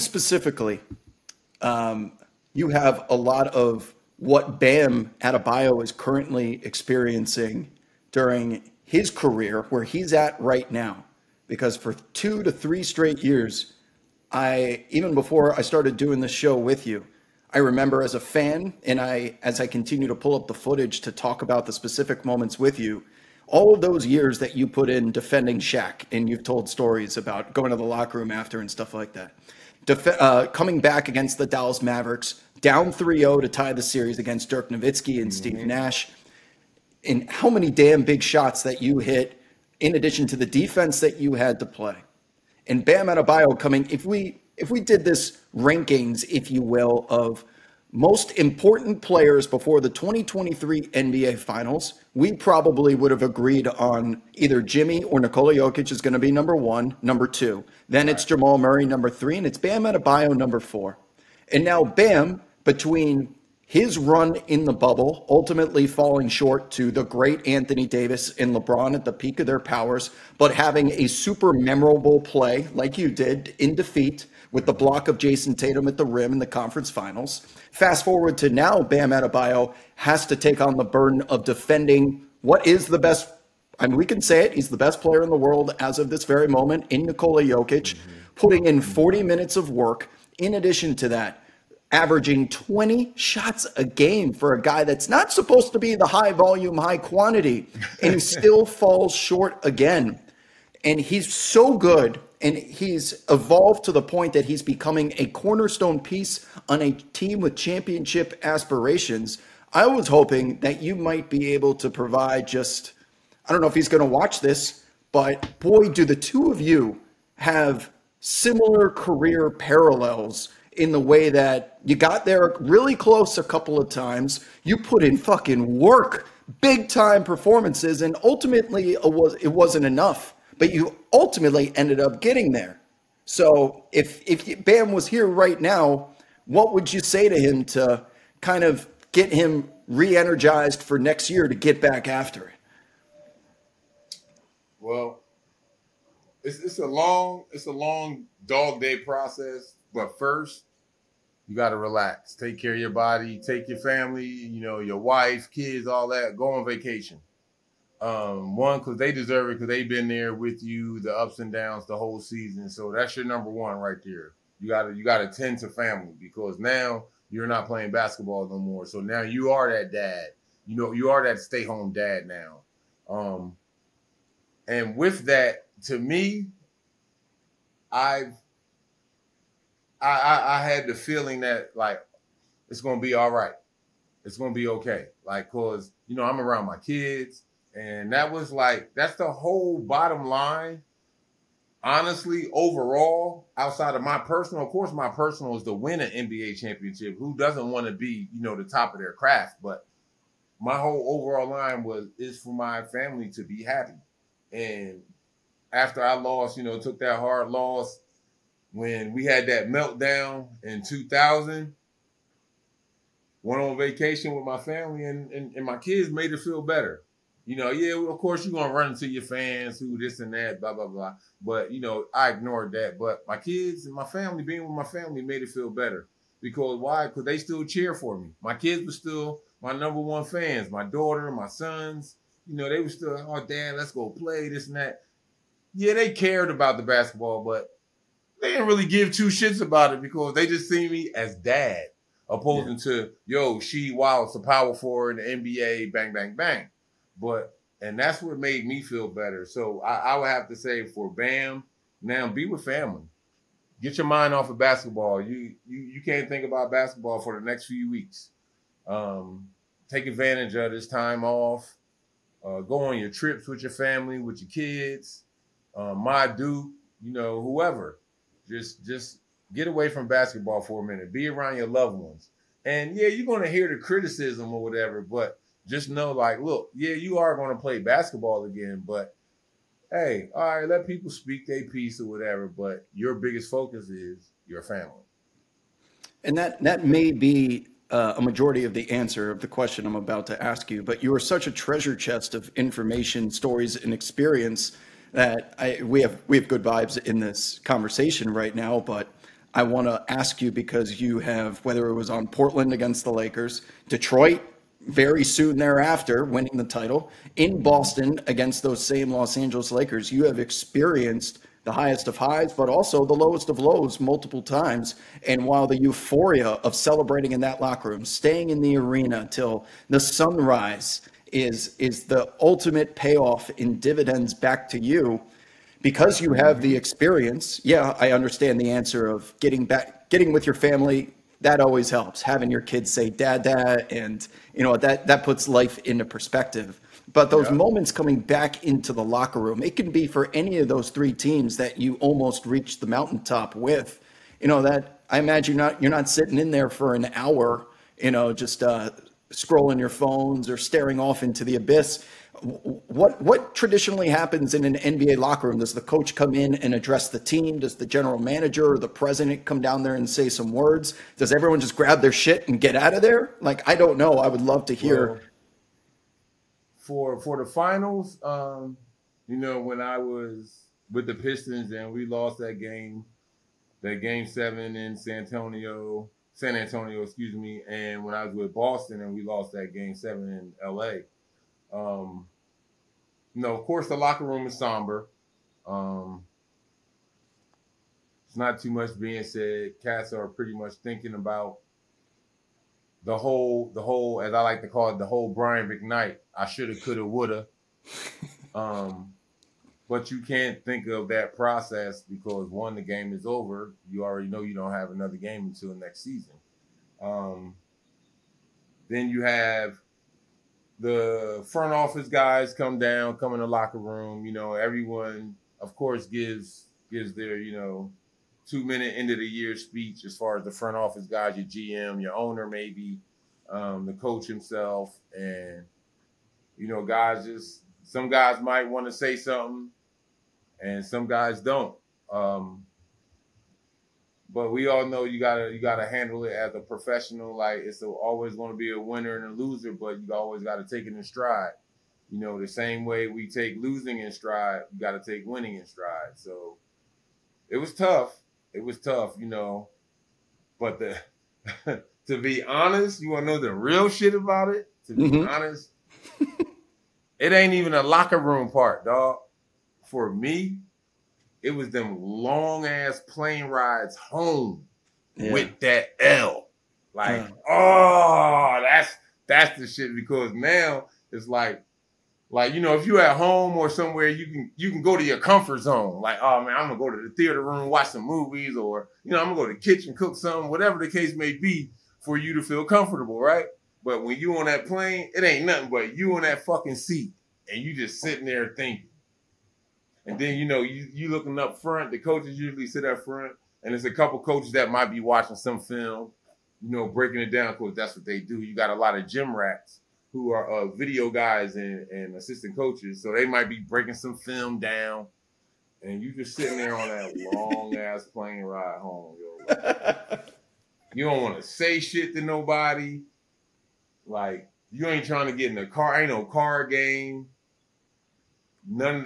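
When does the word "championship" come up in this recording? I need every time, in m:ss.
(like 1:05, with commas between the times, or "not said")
1:47, 3:16.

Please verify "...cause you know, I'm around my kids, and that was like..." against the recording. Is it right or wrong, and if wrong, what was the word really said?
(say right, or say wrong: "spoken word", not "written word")
right.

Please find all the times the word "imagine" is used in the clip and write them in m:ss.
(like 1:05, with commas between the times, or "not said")
5:45.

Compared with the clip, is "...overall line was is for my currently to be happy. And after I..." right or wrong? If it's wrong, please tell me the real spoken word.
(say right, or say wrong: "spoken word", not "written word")
wrong: "family", not "currently".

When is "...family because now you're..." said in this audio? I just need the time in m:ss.
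2:45.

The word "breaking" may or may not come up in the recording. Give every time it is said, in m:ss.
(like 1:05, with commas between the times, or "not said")
8:16, 8:23.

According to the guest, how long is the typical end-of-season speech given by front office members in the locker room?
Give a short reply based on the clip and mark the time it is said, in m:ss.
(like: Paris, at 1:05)
2 minutes, at 6:58.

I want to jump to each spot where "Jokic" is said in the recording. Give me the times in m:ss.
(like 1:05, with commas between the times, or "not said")
0:55, 1:27.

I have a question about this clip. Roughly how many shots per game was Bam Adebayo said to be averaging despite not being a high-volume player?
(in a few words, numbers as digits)
20.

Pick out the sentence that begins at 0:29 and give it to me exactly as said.
Def- uh, coming back against the Dallas Mavericks, down 3-0 to tie the series against Dirk Nowitzki and mm-hmm.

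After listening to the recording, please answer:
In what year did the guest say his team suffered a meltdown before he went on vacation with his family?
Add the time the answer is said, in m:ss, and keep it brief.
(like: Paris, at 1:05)
2000, at 3:30.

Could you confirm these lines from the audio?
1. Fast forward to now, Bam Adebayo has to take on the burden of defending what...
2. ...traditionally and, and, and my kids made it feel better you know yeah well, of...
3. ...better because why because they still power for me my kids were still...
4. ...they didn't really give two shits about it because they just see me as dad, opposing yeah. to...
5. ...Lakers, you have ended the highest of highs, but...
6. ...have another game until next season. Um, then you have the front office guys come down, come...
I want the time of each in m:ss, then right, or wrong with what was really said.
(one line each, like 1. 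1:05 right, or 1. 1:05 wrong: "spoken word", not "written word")
1. 1:17 right
2. 3:34 wrong: "family", not "traditionally"
3. 3:45 wrong: "cheer", not "power"
4. 3:58 right
5. 5:09 wrong: "experienced", not "ended"
6. 6:44 right.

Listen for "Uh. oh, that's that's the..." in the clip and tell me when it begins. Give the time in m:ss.
7:47.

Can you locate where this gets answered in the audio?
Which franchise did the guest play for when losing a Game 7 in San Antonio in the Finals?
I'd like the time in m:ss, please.
6:11.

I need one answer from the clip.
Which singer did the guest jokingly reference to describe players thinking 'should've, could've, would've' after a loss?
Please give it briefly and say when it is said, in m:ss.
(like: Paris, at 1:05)
Brian McKnight, at 6:35.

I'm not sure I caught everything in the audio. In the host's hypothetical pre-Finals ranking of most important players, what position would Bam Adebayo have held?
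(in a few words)
4.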